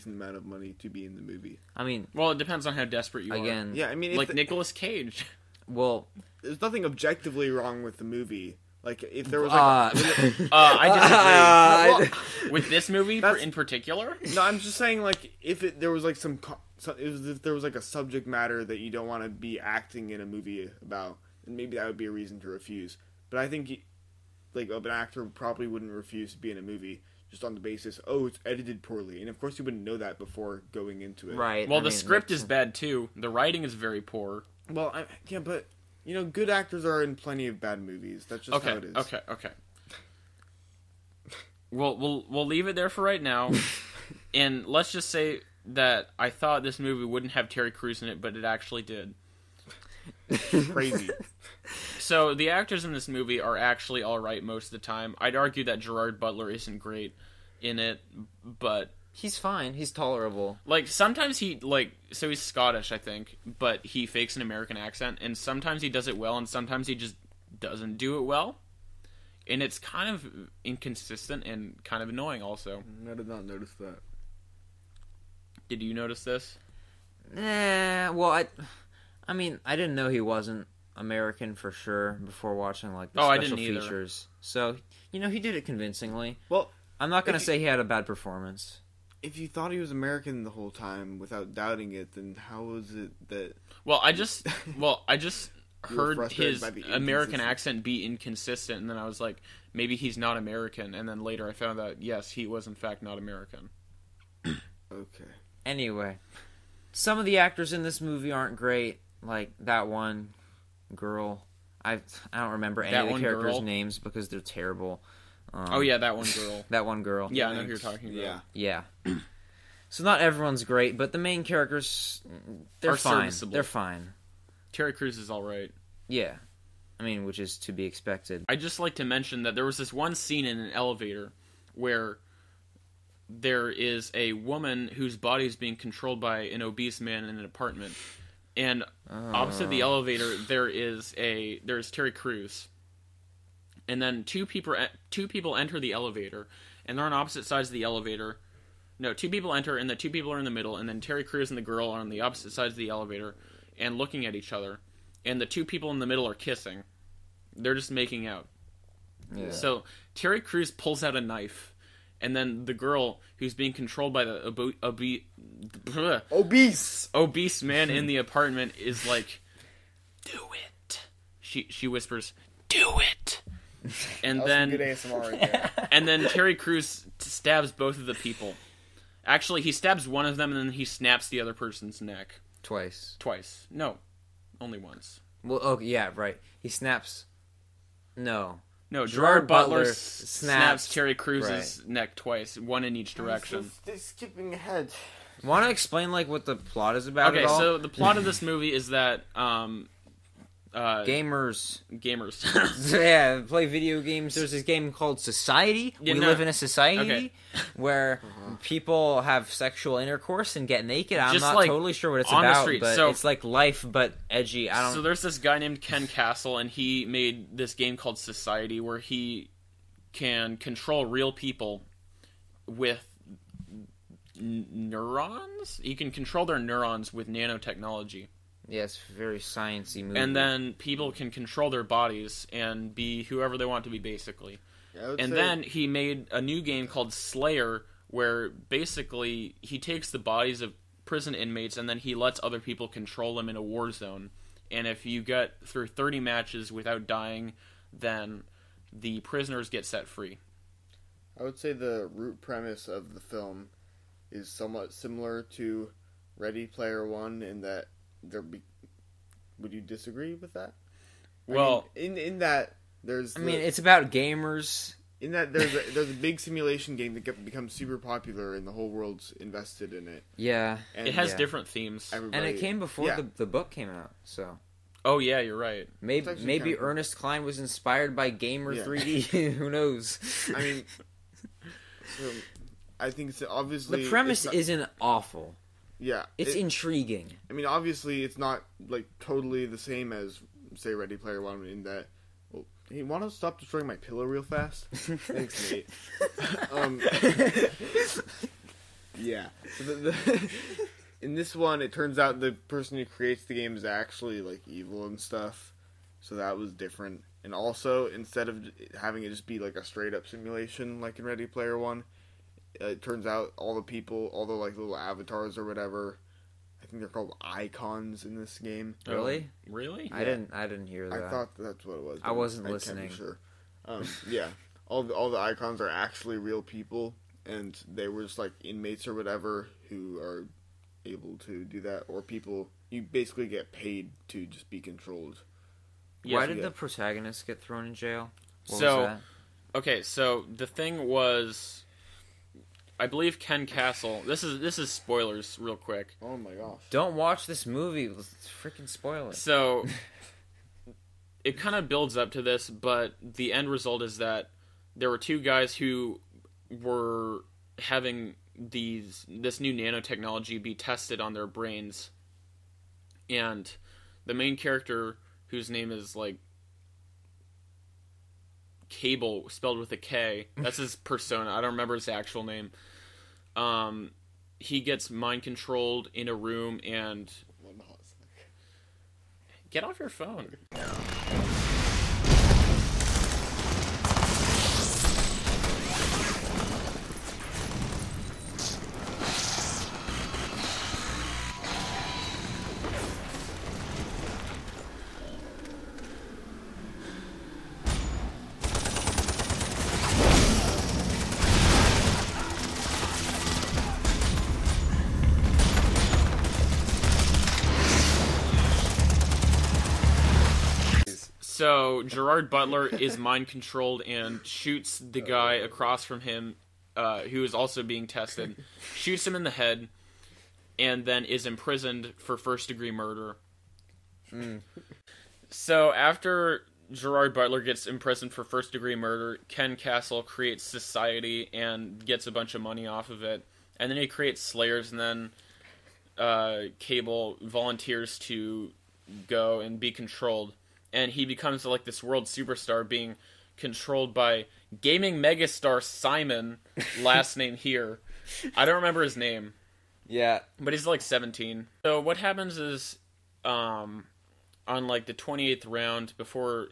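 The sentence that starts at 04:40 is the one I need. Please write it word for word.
I mean, so I think it's obviously the premise not, isn't awful.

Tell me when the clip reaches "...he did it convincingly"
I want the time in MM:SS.
01:25.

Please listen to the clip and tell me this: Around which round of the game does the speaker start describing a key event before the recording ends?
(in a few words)
28th round.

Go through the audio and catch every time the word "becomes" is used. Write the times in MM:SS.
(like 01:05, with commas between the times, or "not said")
04:27, 07:21.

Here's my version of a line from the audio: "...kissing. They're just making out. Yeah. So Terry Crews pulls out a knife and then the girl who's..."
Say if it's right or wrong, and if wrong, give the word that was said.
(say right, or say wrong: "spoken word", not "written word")
right.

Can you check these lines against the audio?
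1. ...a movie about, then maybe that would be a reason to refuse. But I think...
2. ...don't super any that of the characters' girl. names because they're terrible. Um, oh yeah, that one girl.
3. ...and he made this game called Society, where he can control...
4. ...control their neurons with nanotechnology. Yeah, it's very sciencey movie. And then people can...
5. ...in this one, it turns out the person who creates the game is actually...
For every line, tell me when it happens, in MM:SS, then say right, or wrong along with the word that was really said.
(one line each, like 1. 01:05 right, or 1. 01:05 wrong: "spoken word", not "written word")
1. 00:20 right
2. 01:52 wrong: "remember", not "super"
3. 03:36 right
4. 03:46 right
5. 05:01 right.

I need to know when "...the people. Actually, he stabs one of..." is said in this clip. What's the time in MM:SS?
02:58.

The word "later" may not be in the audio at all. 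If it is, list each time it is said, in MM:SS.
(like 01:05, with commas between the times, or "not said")
01:41.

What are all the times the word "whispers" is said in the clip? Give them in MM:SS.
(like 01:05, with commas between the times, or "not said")
02:51.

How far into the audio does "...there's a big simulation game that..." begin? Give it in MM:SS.
04:25.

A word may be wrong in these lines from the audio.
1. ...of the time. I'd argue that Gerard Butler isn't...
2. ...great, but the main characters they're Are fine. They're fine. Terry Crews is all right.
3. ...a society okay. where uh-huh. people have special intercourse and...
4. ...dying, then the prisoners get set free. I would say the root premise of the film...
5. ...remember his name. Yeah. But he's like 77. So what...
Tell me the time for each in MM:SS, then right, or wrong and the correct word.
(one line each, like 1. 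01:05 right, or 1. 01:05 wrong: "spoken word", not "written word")
1. 00:54 right
2. 02:00 right
3. 03:26 wrong: "sexual", not "special"
4. 04:07 right
5. 07:28 wrong: "17", not "77".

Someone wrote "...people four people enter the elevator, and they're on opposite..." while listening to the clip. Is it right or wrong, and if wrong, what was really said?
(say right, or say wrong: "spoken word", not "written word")
wrong: "two", not "four".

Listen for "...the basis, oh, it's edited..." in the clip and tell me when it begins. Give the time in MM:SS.
00:27.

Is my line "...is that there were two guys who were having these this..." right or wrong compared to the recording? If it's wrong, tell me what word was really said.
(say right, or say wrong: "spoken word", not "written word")
right.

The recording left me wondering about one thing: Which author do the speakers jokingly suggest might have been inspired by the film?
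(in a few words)
Ernest Cline.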